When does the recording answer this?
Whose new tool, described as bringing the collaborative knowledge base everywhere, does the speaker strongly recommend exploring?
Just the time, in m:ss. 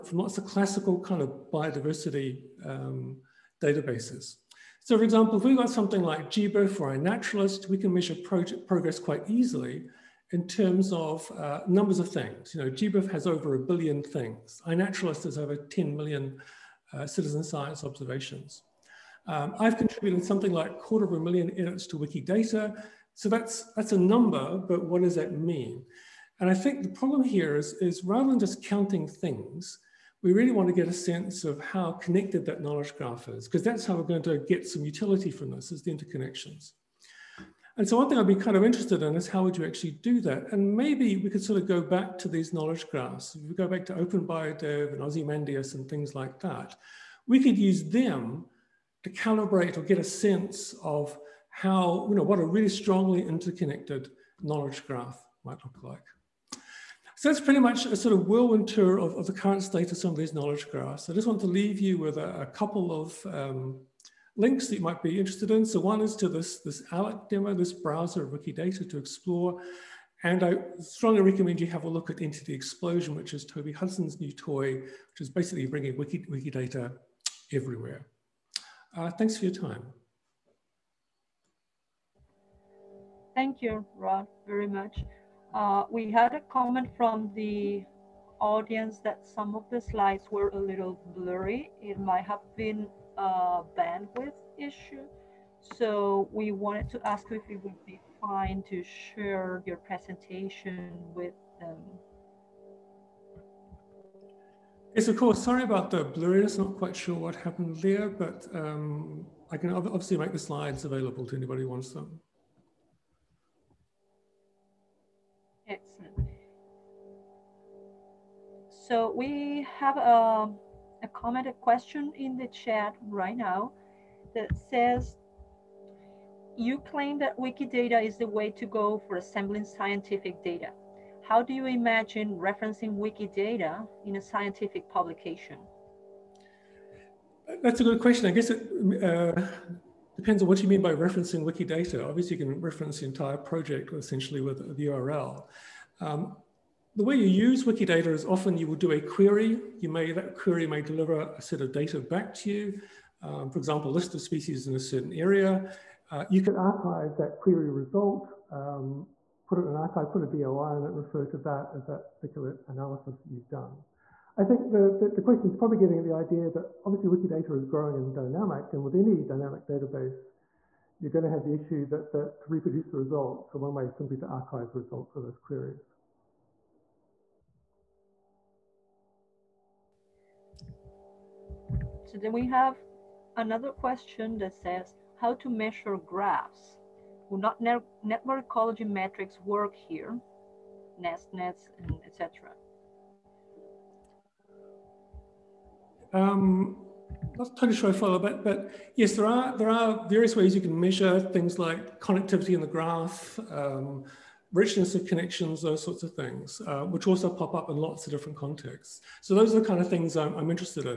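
1:13.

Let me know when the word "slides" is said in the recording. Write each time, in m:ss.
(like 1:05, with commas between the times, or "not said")
1:29, 1:50.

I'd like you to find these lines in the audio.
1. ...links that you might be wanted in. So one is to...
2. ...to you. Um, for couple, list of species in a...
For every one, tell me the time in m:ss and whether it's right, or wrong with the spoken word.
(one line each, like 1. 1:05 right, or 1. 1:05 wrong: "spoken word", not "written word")
1. 1:04 wrong: "interested", not "wanted"
2. 2:32 wrong: "example", not "couple".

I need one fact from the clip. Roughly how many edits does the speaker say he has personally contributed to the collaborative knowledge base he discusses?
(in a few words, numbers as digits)
quarter of a million.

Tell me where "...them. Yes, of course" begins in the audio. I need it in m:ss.
1:41.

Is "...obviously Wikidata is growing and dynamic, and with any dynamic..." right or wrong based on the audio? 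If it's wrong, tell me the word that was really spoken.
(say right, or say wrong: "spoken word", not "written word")
right.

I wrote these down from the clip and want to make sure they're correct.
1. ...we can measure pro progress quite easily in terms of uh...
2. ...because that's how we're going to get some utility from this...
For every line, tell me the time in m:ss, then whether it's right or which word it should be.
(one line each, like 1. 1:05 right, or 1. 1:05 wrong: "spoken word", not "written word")
1. 0:07 right
2. 0:33 right.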